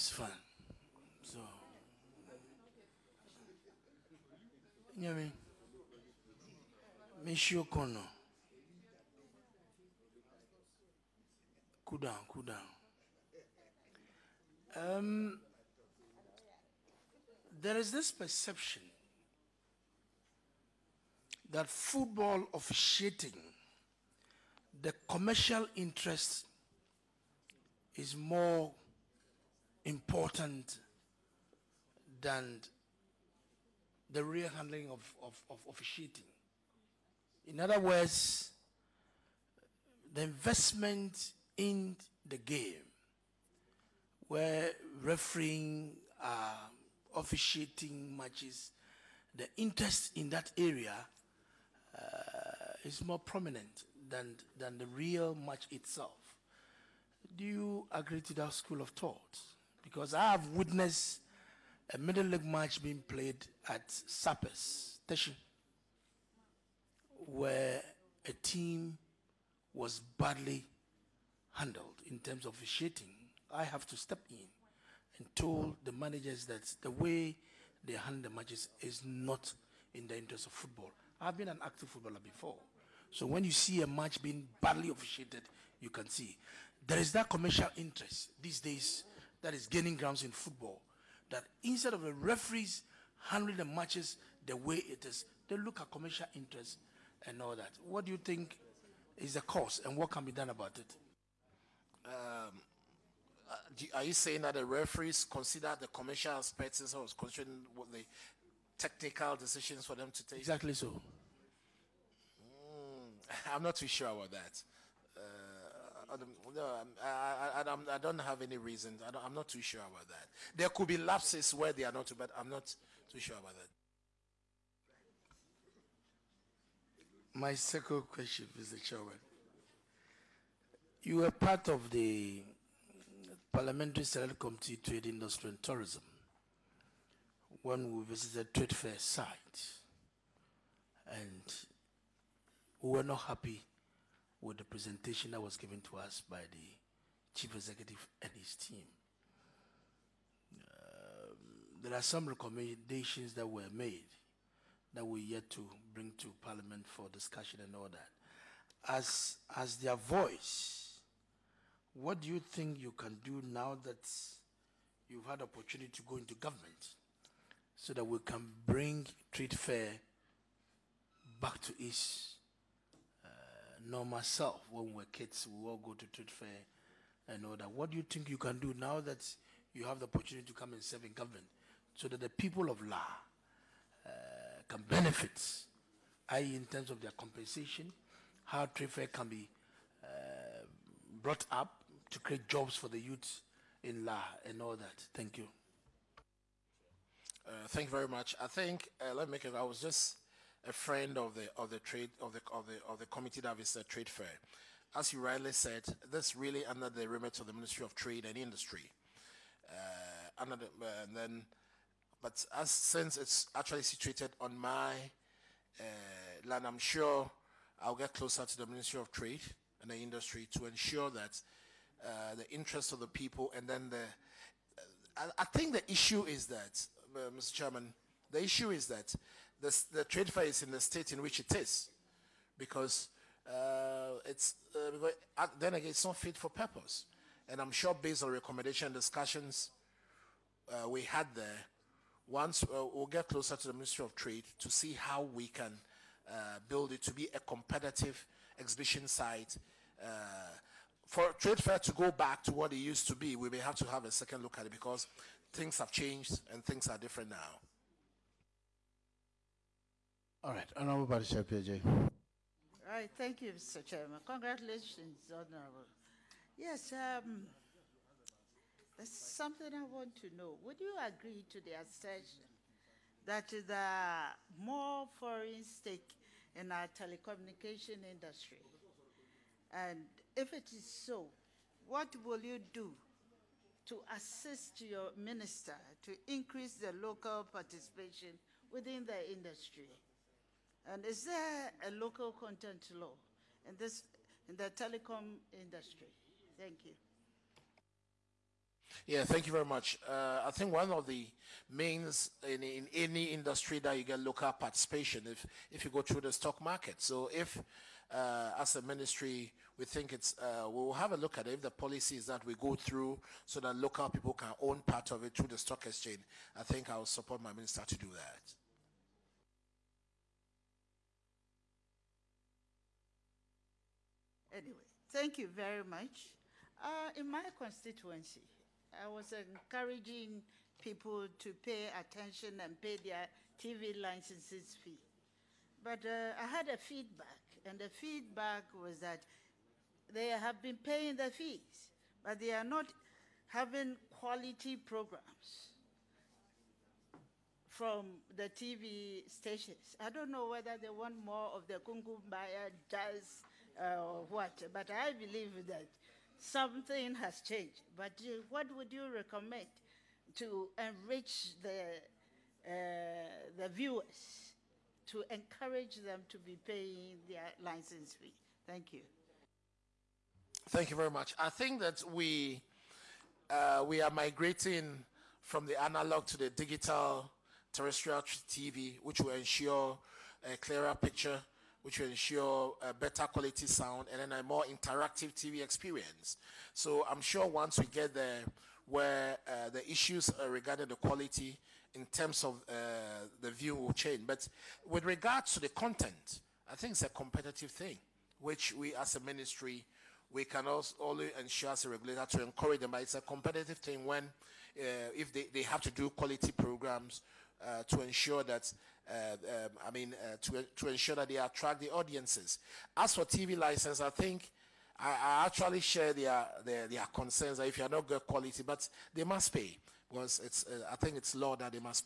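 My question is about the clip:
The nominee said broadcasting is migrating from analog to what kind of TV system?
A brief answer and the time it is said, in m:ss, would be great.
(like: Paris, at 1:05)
Digital terrestrial TV, at 6:16.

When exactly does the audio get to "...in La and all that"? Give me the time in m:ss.
3:13.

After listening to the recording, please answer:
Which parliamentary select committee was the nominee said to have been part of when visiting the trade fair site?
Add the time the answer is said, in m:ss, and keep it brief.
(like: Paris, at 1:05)
Trade Industry and Tourism, at 2:14.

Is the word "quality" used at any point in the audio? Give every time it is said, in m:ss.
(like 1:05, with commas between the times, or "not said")
5:44, 6:23, 6:30, 6:46, 6:58.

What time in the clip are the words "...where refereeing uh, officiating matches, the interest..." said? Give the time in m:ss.
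0:44.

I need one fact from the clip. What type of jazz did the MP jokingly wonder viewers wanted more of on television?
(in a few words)
Kungumbaya jazz.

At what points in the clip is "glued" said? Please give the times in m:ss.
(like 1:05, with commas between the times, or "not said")
not said.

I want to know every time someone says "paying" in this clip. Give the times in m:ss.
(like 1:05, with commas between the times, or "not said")
5:40, 6:06.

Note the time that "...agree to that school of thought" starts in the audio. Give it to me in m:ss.
0:57.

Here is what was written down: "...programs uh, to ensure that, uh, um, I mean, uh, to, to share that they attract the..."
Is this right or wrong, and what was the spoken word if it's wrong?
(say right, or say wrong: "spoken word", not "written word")
wrong: "ensure", not "share".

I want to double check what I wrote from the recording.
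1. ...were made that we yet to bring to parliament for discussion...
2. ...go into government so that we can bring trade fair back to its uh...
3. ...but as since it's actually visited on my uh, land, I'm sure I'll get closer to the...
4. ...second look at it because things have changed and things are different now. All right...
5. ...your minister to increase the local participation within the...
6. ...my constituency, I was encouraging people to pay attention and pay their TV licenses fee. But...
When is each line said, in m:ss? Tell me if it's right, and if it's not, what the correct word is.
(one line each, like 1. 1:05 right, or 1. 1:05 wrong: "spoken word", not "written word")
1. 2:33 right
2. 2:46 right
3. 3:32 wrong: "situated", not "visited"
4. 4:14 right
5. 4:44 right
6. 5:27 right.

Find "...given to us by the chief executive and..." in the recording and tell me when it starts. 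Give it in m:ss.
2:25.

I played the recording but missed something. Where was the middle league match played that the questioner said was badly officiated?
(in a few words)
Sappers Station.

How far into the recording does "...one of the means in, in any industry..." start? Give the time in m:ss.
5:00.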